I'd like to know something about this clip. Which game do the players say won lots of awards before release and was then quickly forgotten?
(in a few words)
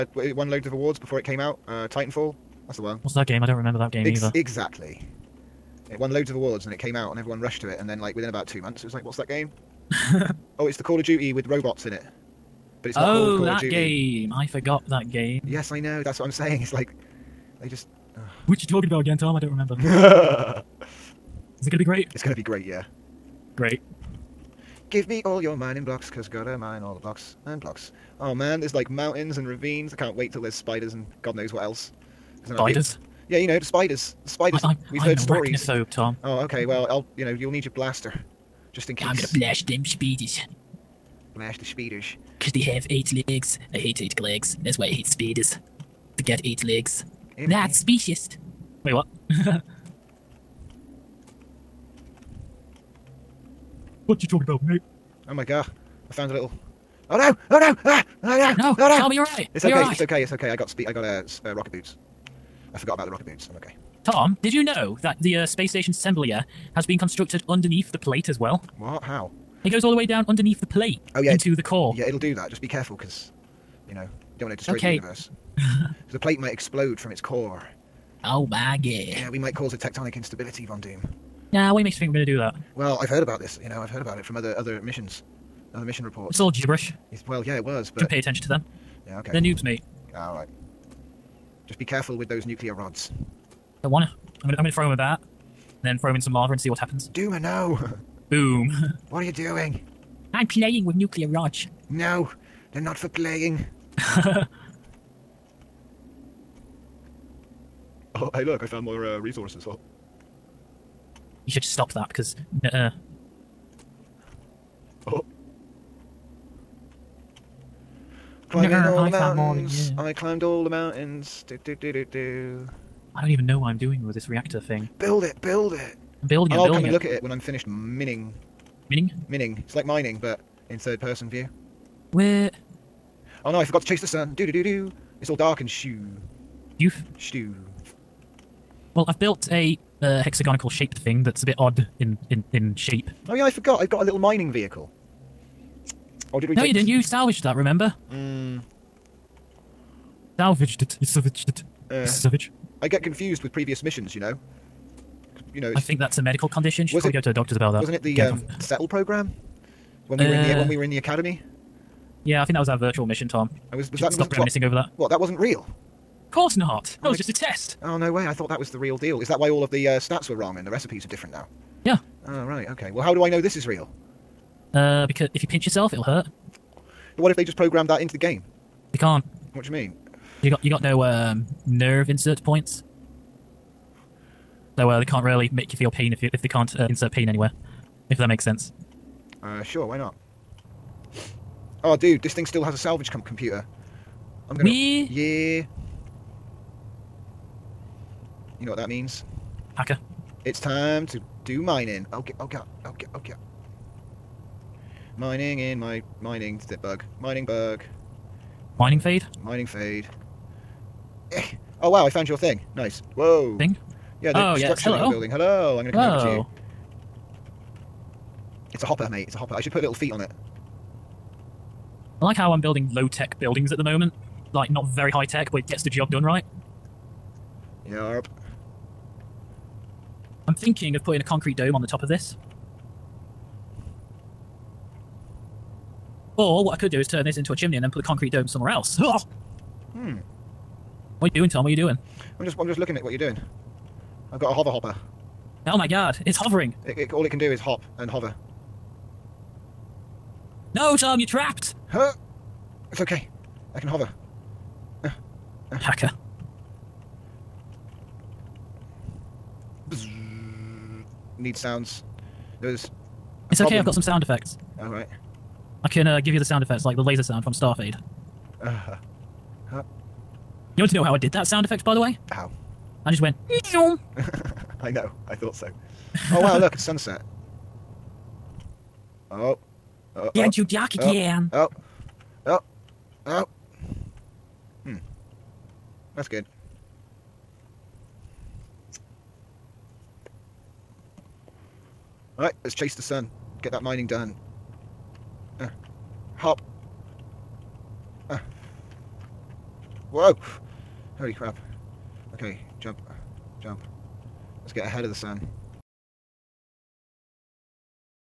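Titanfall.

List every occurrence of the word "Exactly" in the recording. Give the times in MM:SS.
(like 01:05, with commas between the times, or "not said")
00:04.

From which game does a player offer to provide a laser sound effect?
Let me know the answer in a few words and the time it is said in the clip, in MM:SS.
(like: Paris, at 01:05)
StarMade, at 04:27.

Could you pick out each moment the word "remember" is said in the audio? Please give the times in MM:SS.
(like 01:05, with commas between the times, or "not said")
00:03, 00:19, 02:27.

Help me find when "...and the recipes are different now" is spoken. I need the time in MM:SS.
02:50.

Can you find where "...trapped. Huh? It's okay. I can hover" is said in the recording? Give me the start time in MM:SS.
04:11.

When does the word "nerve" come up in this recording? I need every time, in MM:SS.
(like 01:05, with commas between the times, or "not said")
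03:01.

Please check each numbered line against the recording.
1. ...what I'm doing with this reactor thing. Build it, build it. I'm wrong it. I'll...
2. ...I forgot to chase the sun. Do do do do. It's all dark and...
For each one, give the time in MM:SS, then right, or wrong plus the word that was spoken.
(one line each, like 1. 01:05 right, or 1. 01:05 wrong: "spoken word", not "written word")
1. 02:03 wrong: "building", not "wrong"
2. 02:13 right.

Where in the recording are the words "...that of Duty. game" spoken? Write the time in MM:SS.
00:13.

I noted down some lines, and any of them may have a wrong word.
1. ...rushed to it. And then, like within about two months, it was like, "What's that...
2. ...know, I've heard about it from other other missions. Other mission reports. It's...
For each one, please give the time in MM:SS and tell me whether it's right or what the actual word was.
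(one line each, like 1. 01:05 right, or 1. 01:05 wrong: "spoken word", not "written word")
1. 00:07 right
2. 01:23 right.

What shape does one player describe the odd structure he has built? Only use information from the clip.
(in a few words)
hexagonal.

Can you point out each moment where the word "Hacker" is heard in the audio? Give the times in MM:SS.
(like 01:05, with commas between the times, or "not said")
03:19, 04:15.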